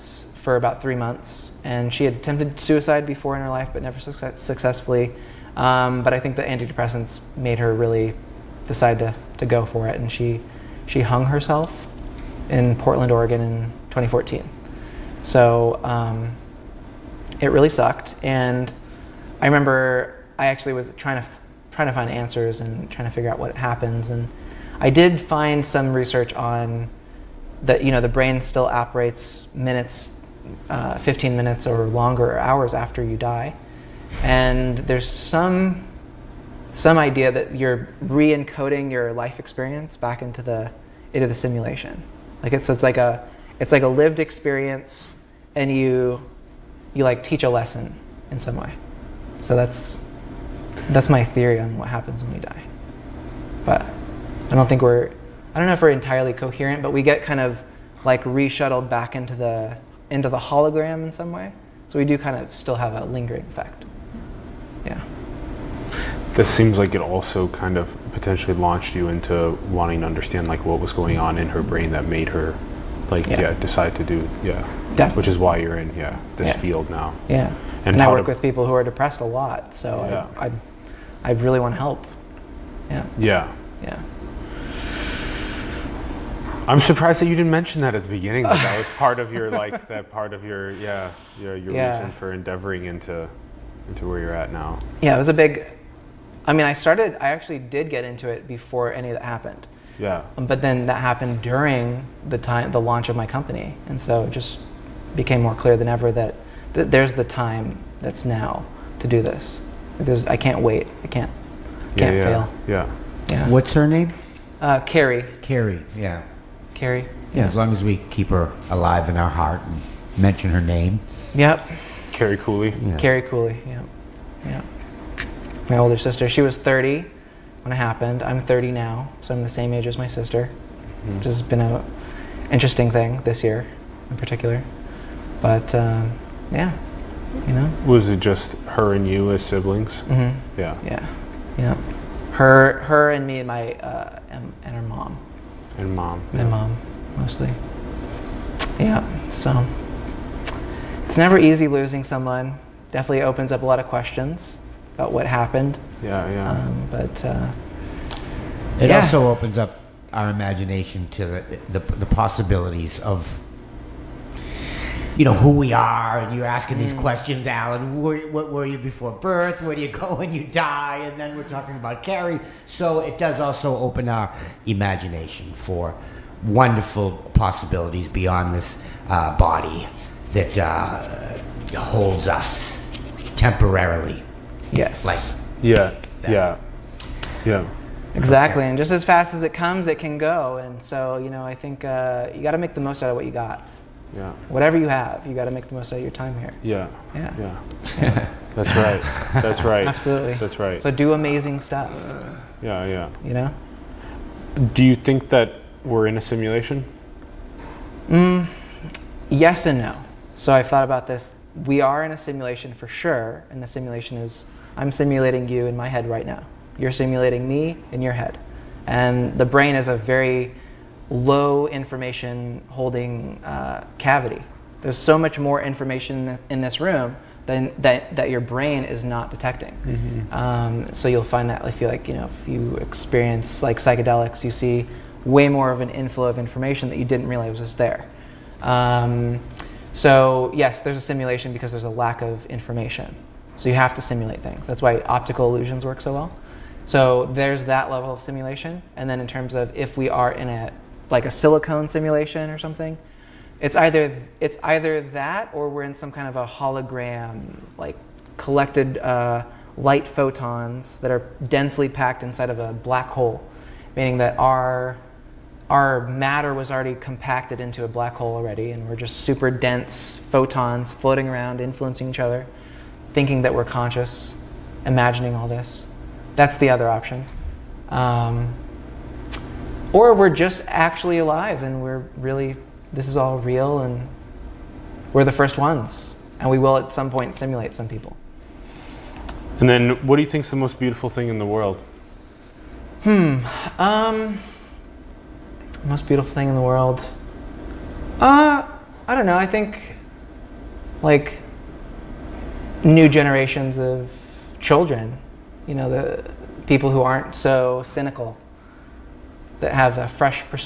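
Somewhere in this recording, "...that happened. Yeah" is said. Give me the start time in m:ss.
1:39.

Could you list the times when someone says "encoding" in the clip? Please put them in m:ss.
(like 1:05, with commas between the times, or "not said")
0:38.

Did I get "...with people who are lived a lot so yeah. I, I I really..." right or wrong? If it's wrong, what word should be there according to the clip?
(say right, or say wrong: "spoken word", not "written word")
wrong: "depressed", not "lived".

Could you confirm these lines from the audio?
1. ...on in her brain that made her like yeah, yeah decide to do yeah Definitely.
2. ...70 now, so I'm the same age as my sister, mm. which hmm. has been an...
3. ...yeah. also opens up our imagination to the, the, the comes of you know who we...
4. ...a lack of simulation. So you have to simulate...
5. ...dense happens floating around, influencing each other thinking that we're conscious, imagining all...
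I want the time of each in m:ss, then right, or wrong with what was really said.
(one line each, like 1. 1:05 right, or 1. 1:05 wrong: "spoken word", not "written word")
1. 1:11 right
2. 2:08 wrong: "30", not "70"
3. 2:38 wrong: "possibilities", not "comes"
4. 4:01 wrong: "information", not "simulation"
5. 4:29 wrong: "photons", not "happens".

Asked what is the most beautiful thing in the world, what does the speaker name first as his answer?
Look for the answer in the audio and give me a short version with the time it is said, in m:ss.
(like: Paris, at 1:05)
New generations of children, at 5:02.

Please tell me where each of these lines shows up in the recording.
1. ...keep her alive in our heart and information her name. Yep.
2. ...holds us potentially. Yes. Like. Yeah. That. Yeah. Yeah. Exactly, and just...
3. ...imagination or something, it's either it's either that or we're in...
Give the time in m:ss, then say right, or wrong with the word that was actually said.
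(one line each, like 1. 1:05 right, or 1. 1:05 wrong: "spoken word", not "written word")
1. 1:58 wrong: "mention", not "information"
2. 3:01 wrong: "temporarily", not "potentially"
3. 4:11 wrong: "simulation", not "imagination".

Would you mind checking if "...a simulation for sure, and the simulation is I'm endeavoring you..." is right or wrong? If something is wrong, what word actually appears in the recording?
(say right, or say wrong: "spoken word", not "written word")
wrong: "simulating", not "endeavoring".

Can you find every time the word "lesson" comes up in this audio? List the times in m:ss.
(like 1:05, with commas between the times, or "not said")
0:47.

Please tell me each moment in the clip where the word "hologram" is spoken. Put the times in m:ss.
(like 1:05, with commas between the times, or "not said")
1:00, 4:16.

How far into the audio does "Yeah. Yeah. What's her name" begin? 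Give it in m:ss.
1:52.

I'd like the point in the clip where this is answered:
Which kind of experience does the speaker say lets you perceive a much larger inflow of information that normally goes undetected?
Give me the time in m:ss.
3:53.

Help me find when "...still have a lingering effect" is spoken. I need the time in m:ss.
1:02.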